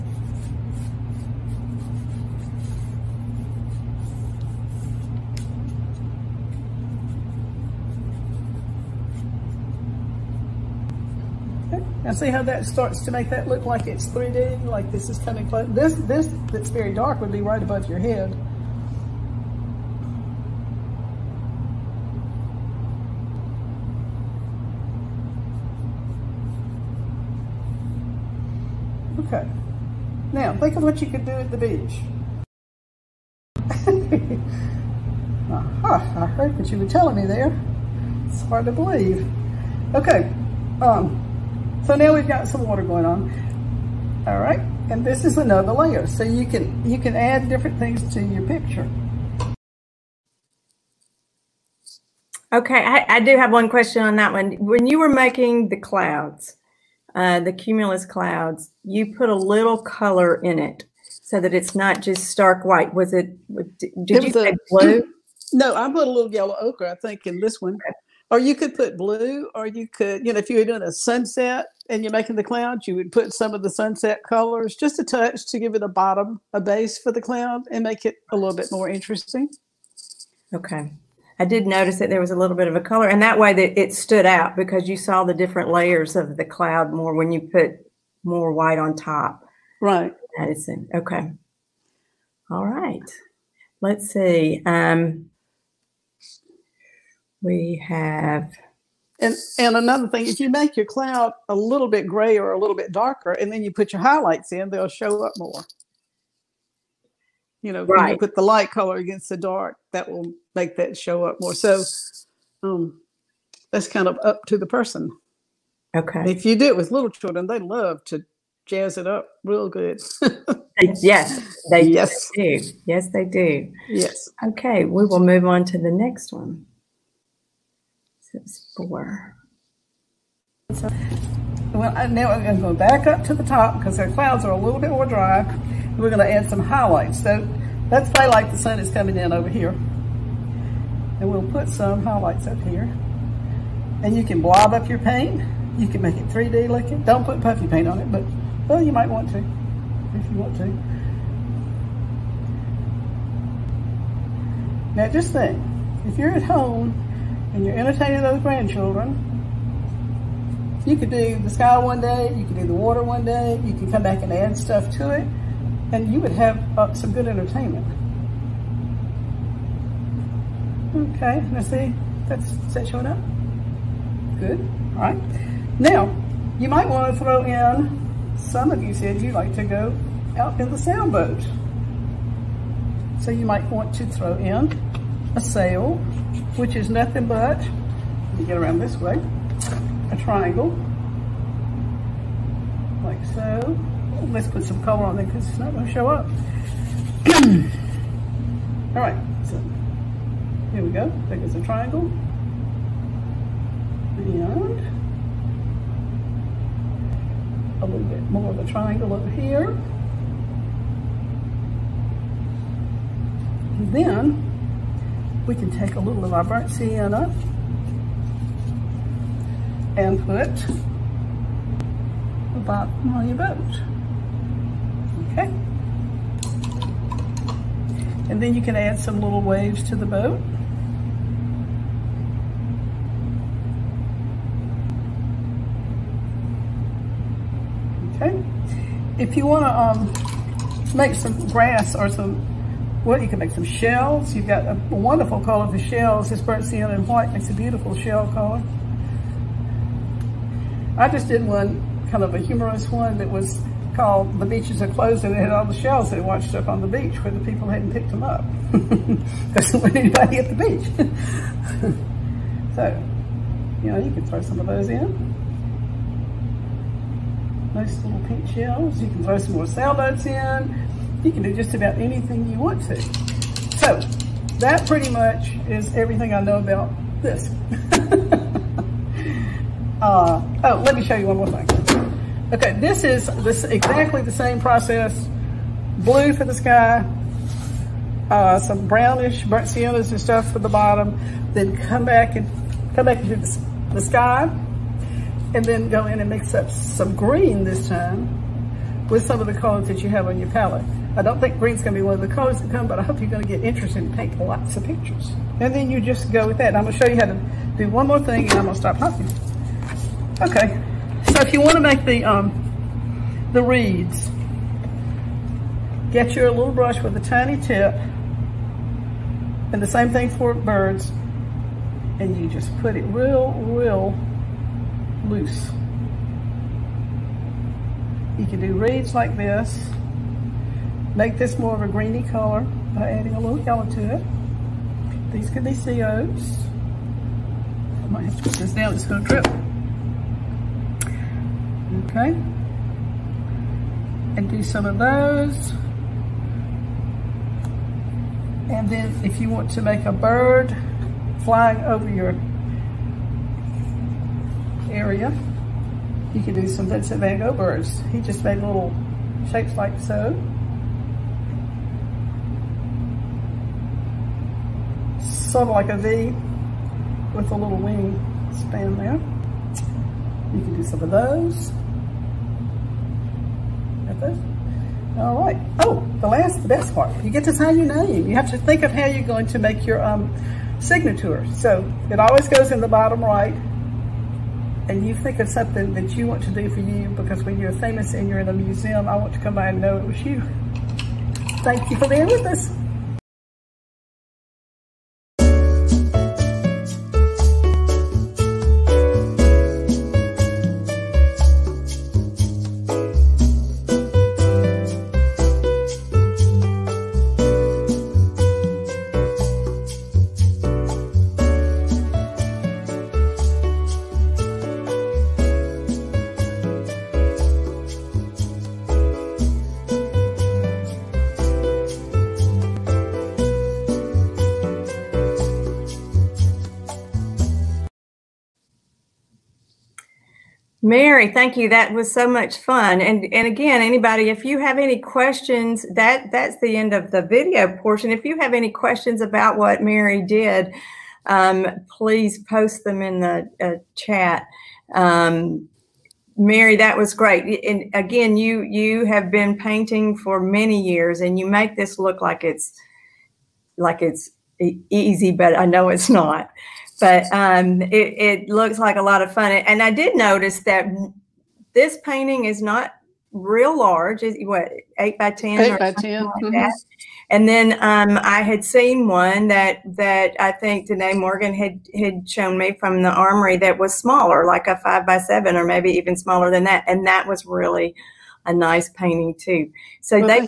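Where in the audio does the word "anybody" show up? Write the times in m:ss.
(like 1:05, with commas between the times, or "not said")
4:19, 7:13.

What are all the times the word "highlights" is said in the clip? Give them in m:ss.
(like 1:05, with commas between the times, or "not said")
1:44, 2:16, 2:22.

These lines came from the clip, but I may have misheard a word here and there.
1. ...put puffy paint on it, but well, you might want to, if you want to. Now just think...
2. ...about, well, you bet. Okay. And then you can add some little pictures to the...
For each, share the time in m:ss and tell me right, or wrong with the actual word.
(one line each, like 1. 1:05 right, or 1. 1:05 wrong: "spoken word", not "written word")
1. 2:27 right
2. 3:42 wrong: "waves", not "pictures".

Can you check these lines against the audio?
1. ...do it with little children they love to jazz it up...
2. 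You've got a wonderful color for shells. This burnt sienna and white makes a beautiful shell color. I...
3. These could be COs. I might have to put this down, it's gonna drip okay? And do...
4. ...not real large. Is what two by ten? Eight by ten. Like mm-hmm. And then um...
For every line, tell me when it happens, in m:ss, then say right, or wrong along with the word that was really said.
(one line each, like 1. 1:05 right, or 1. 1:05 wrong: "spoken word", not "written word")
1. 1:56 right
2. 4:04 right
3. 5:35 right
4. 7:42 wrong: "eight", not "two".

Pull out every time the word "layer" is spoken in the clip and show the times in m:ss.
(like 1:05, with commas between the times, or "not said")
0:45, 1:25.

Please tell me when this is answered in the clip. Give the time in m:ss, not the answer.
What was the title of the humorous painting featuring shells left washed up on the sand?
4:14.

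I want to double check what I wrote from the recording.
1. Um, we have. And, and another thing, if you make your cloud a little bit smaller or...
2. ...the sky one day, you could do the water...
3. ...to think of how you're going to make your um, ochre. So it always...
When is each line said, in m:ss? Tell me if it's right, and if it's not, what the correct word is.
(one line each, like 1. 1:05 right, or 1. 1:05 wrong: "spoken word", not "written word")
1. 1:34 wrong: "grayer", not "smaller"
2. 2:41 right
3. 6:18 wrong: "signature", not "ochre".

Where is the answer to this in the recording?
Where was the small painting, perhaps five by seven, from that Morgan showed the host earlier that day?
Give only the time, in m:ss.
7:53.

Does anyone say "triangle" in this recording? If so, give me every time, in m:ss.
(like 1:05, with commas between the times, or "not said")
3:10, 3:21, 3:28.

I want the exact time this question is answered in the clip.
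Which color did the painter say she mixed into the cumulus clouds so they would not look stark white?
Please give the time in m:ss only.
1:06.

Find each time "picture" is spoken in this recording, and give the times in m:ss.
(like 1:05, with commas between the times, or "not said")
0:48, 5:04.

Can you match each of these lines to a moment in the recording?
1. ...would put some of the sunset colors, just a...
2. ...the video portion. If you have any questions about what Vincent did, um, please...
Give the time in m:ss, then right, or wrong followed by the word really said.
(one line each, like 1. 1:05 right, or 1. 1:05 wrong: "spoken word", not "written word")
1. 1:12 right
2. 7:17 wrong: "Mary", not "Vincent".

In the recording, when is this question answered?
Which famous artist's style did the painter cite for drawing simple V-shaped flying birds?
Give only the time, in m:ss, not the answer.
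5:56.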